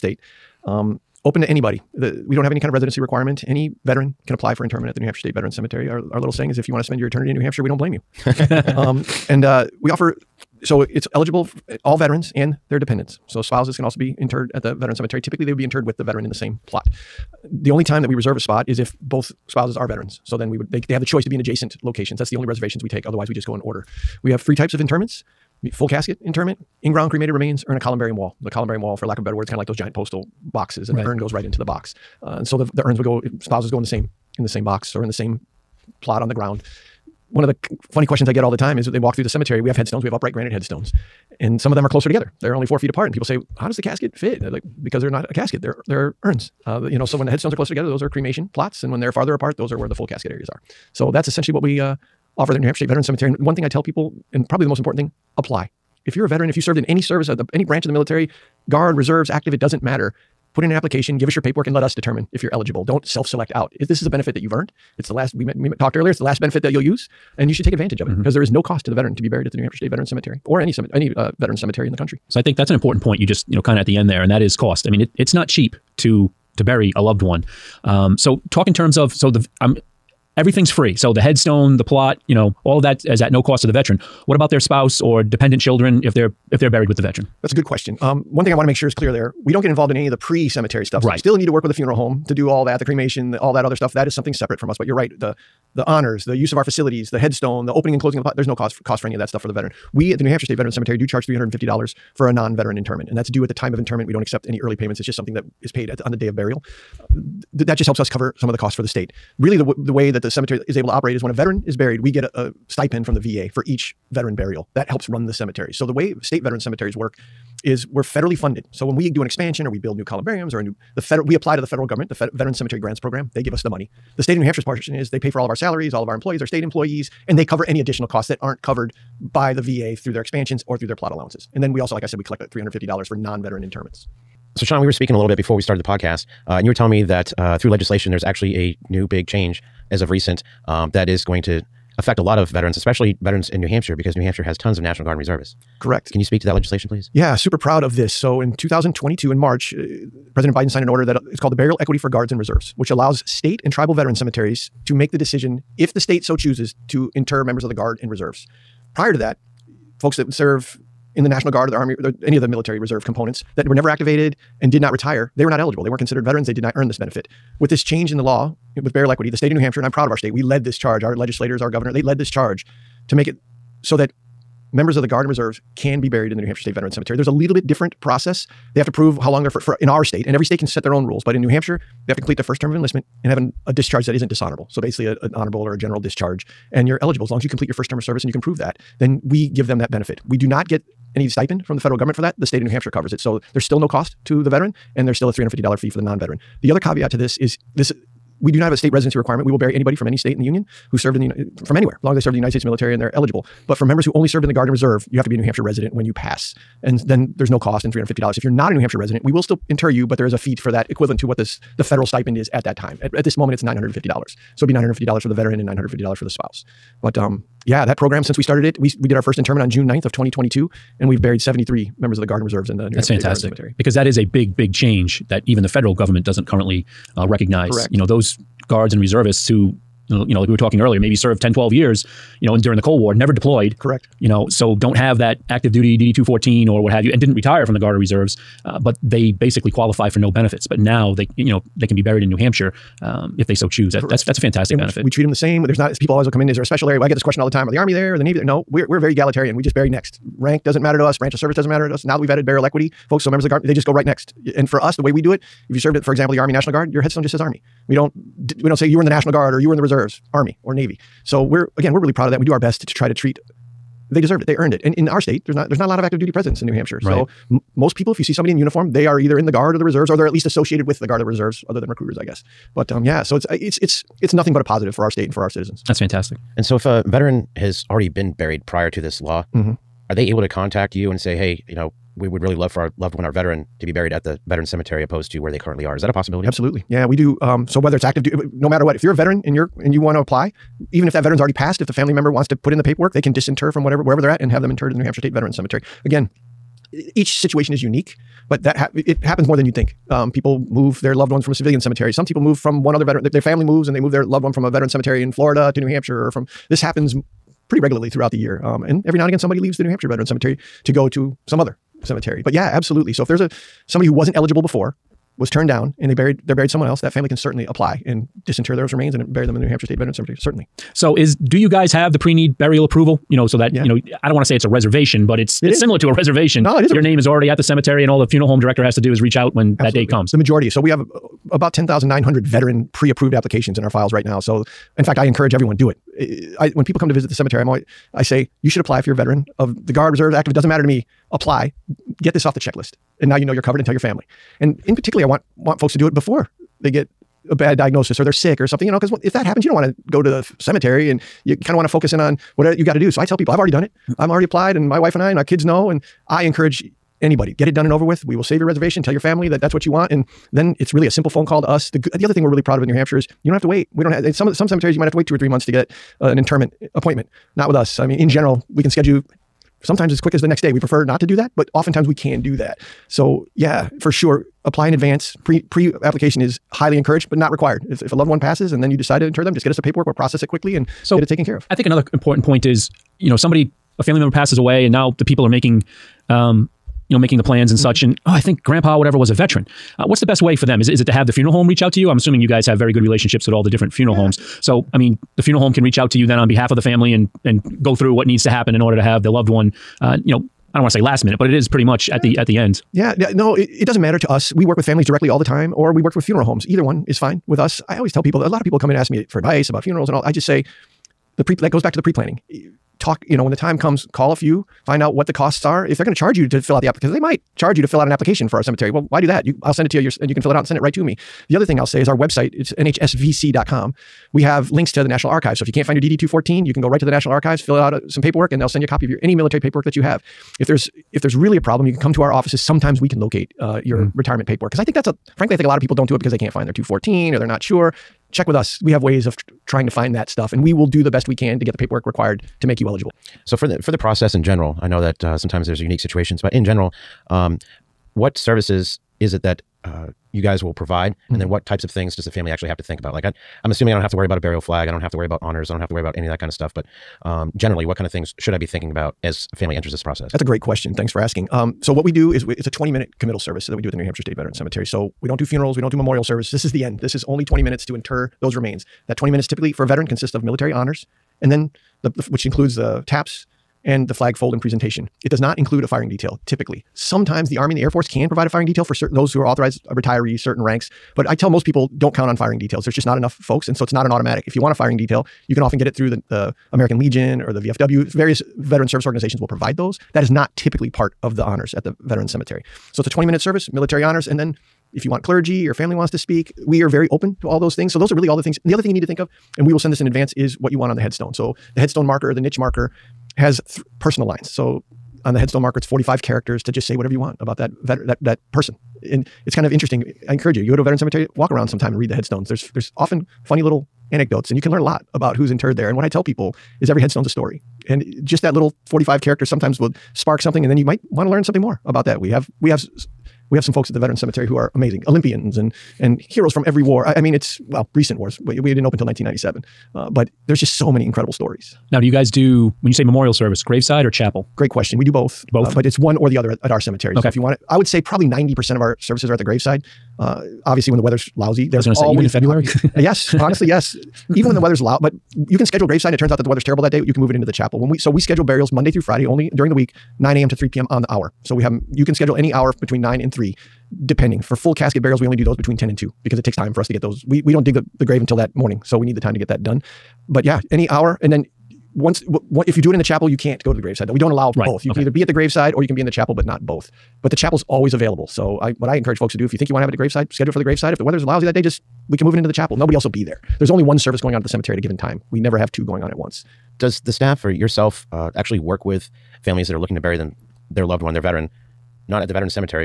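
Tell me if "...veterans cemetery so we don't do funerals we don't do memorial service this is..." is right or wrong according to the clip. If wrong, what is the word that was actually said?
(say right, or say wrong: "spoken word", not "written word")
right.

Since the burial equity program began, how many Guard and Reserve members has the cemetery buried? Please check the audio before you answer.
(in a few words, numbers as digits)
73.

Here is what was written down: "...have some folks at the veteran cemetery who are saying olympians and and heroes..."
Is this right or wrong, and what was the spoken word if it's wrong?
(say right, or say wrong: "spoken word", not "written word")
wrong: "amazing", not "saying".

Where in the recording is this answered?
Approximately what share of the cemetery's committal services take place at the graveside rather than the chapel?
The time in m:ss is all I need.
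8:58.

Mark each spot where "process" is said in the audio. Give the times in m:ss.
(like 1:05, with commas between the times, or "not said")
2:58, 6:20, 7:23, 7:40.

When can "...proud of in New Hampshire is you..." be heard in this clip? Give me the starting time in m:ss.
6:02.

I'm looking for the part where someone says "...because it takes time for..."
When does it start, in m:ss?
9:16.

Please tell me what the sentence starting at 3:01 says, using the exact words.
But in New Hampshire, they have to complete their first term of enlistment and have an, a discharge that isn't dishonorable.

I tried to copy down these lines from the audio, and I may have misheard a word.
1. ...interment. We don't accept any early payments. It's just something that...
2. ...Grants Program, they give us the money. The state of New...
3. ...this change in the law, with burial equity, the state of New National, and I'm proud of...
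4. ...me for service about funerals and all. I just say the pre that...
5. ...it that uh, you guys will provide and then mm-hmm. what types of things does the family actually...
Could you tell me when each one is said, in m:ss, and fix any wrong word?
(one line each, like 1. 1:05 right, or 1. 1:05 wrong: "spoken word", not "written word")
1. 1:43 right
2. 2:02 right
3. 2:47 wrong: "Hampshire", not "National"
4. 6:49 wrong: "advice", not "service"
5. 7:29 right.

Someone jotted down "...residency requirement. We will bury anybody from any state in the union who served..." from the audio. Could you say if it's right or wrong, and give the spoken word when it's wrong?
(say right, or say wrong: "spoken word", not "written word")
right.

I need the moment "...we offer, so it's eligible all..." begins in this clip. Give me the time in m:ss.
0:09.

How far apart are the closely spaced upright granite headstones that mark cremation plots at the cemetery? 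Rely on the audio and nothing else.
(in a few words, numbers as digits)
4 feet.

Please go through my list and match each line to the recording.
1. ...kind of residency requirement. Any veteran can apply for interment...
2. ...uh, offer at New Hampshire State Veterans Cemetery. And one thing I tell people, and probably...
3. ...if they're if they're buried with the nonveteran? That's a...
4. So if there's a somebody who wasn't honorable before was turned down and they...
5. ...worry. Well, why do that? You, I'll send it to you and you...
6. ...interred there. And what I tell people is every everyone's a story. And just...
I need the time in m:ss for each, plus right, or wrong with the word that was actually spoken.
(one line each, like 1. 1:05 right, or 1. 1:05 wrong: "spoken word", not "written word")
1. 0:02 right
2. 0:51 right
3. 1:26 wrong: "veteran", not "nonveteran"
4. 5:13 wrong: "eligible", not "honorable"
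5. 6:58 wrong: "cemetery", not "worry"
6. 8:35 wrong: "headstone", not "everyone".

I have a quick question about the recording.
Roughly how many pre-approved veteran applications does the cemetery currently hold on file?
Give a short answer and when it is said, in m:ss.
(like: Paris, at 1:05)
10,900, at 5:31.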